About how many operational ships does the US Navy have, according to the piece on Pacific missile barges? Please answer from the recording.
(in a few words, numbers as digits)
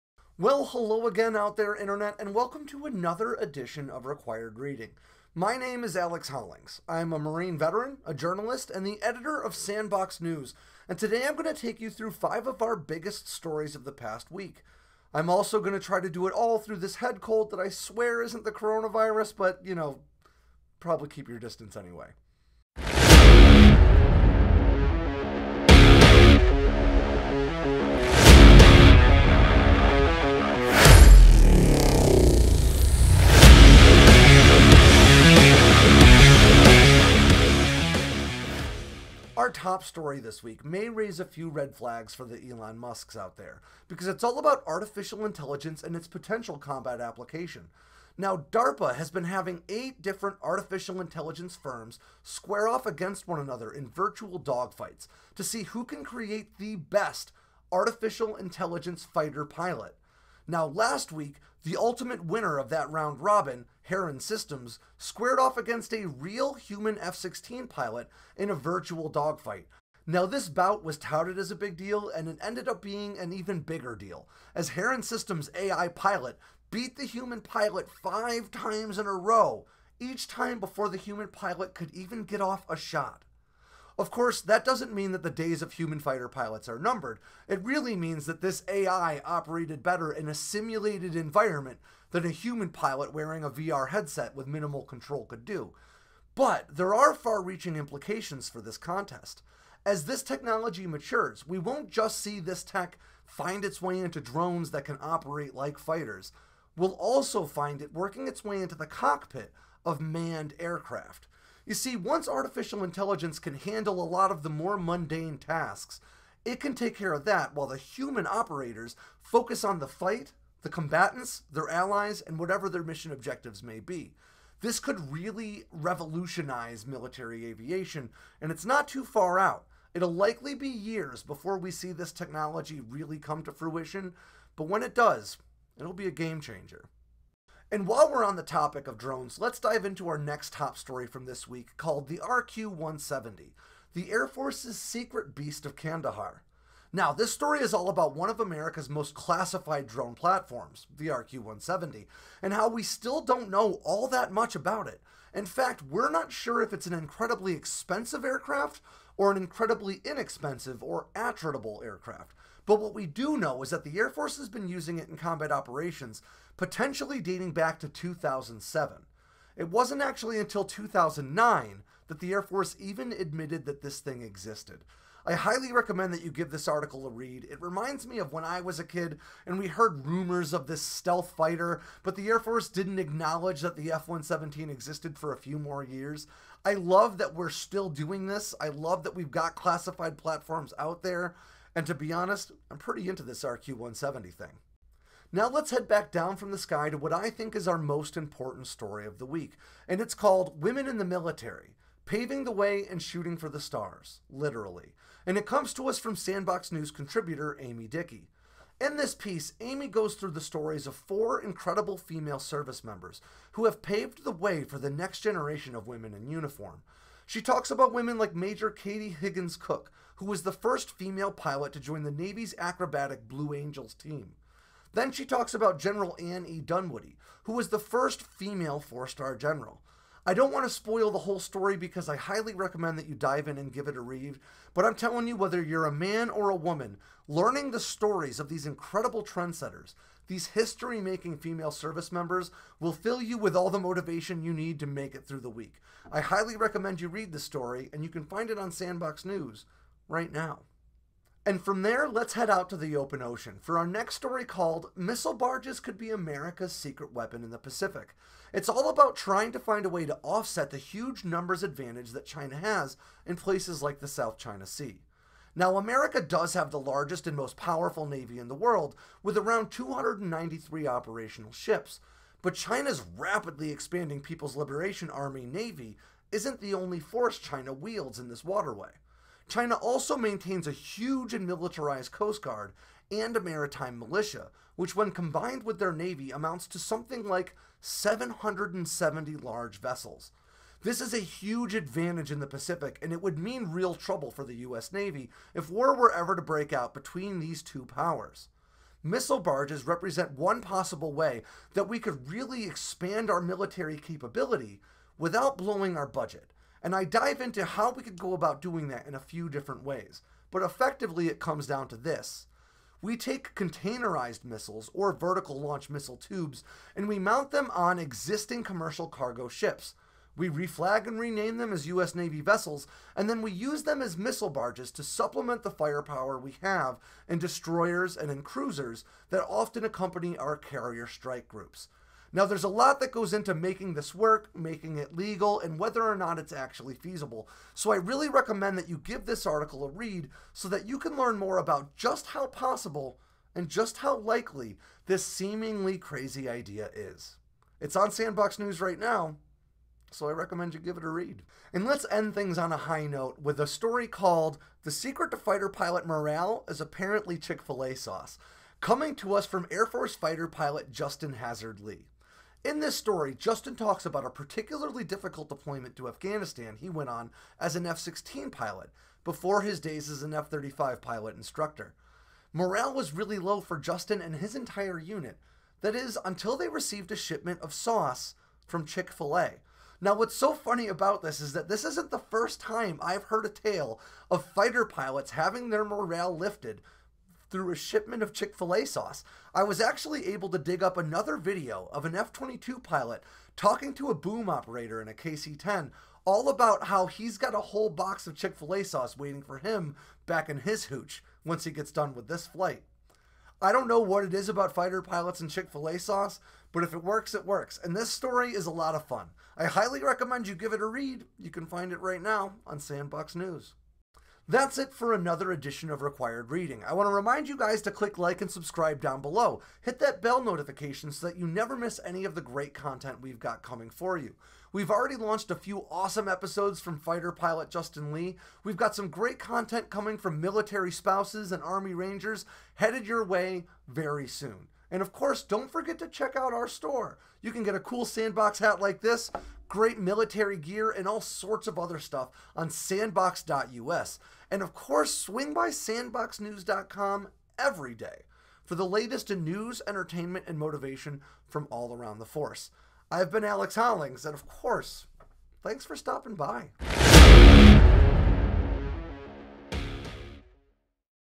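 293.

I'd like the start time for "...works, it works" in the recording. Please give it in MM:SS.
06:47.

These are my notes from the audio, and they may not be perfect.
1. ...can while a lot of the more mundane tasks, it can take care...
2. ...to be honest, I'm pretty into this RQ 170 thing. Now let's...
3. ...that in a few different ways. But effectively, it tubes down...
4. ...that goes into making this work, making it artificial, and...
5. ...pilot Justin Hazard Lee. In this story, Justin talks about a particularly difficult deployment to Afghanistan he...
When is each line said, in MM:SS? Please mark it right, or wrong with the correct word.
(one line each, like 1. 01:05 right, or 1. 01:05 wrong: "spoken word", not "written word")
1. 01:53 wrong: "handle", not "while"
2. 03:11 right
3. 05:08 wrong: "comes", not "tubes"
4. 05:33 wrong: "legal", not "artificial"
5. 06:00 right.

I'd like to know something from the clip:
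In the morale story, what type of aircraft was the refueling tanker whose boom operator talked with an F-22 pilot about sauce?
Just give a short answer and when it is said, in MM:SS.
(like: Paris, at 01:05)
KC-10, at 06:35.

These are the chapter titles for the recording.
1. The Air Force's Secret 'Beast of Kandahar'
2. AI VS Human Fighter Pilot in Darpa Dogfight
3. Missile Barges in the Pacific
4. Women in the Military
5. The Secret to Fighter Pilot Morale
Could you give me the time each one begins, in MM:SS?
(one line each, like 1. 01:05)
1. 02:23
2. 00:44
3. 04:14
4. 03:20
5. 05:54.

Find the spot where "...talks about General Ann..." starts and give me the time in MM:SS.
03:45.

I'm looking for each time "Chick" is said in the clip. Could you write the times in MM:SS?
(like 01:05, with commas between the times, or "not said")
05:57, 06:18, 06:28, 06:38, 06:45.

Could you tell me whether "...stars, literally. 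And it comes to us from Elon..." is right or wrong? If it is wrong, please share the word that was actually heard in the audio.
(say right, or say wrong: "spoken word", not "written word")
wrong: "Sandboxx", not "Elon".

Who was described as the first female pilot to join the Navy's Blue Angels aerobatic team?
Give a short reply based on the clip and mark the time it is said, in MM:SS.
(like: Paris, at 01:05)
Katie Higgins Cook, at 03:38.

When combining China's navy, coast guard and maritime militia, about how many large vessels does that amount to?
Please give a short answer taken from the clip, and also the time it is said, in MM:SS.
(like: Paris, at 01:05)
770, at 04:47.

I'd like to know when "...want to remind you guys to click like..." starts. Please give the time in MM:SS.
06:56.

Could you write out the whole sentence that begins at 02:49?
It wasn't actually until 2009 that the Air Force even admitted that this thing existed.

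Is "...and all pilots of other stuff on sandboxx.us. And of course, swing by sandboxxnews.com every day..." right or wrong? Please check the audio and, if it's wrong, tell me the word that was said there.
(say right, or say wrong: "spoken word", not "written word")
wrong: "sorts", not "pilots".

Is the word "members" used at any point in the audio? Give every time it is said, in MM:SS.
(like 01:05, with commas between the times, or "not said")
03:32, 04:02.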